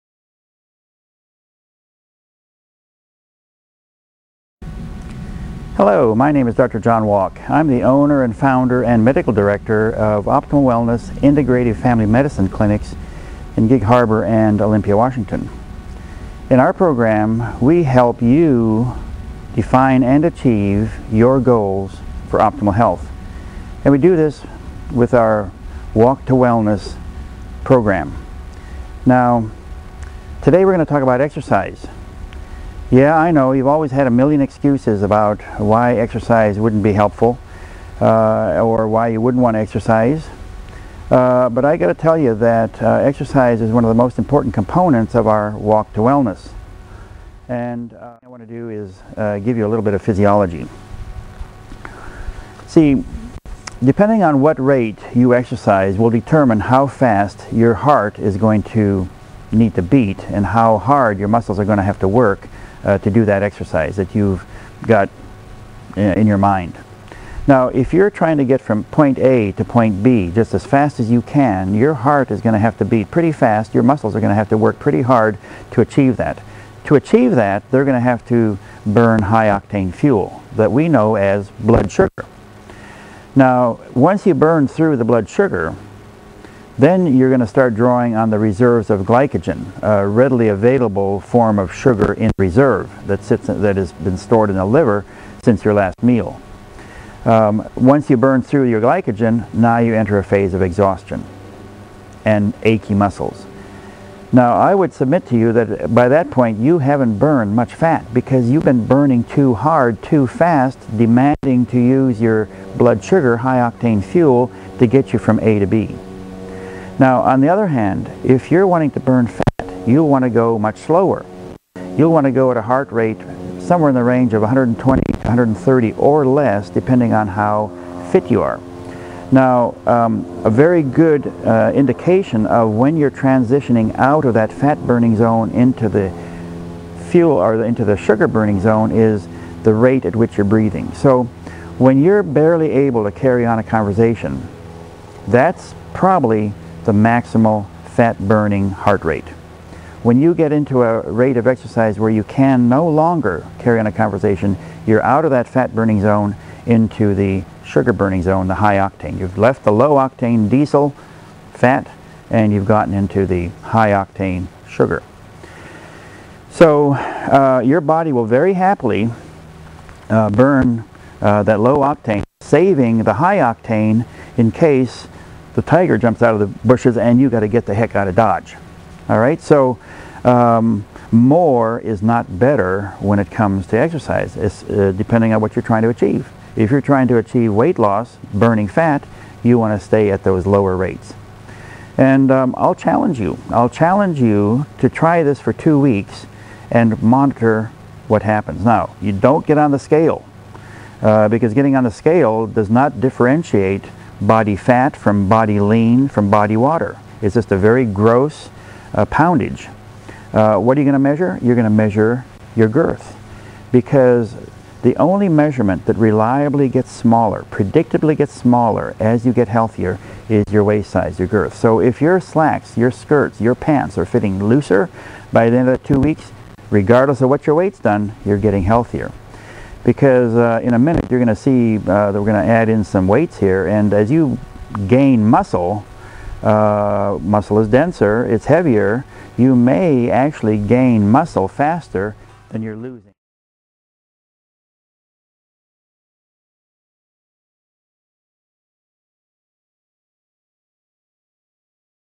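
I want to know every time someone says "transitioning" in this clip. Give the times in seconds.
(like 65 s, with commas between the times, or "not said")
133 s.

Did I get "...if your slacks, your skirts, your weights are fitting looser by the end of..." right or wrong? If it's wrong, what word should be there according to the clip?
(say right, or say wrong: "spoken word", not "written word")
wrong: "pants", not "weights".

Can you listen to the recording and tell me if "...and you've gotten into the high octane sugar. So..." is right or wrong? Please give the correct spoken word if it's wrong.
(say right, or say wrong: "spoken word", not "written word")
right.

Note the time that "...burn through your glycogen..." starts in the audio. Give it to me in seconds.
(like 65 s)
98 s.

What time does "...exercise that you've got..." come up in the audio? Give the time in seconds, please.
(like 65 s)
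63 s.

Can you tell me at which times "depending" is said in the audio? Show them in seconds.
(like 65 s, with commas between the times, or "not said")
53 s, 126 s, 184 s.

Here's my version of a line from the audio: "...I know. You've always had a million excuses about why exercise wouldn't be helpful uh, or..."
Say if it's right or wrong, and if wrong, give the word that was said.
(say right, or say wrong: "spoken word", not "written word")
right.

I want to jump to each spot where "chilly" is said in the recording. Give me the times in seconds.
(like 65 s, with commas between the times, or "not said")
not said.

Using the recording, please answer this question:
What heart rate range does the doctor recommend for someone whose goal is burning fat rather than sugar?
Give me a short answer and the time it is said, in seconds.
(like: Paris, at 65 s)
120 to 130, at 124 s.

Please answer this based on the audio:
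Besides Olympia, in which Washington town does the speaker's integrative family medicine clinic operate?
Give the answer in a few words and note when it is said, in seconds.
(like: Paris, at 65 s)
Gig Harbor, at 13 s.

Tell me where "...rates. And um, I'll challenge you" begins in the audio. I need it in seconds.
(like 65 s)
190 s.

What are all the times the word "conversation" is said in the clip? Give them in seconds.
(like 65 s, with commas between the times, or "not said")
143 s, 153 s.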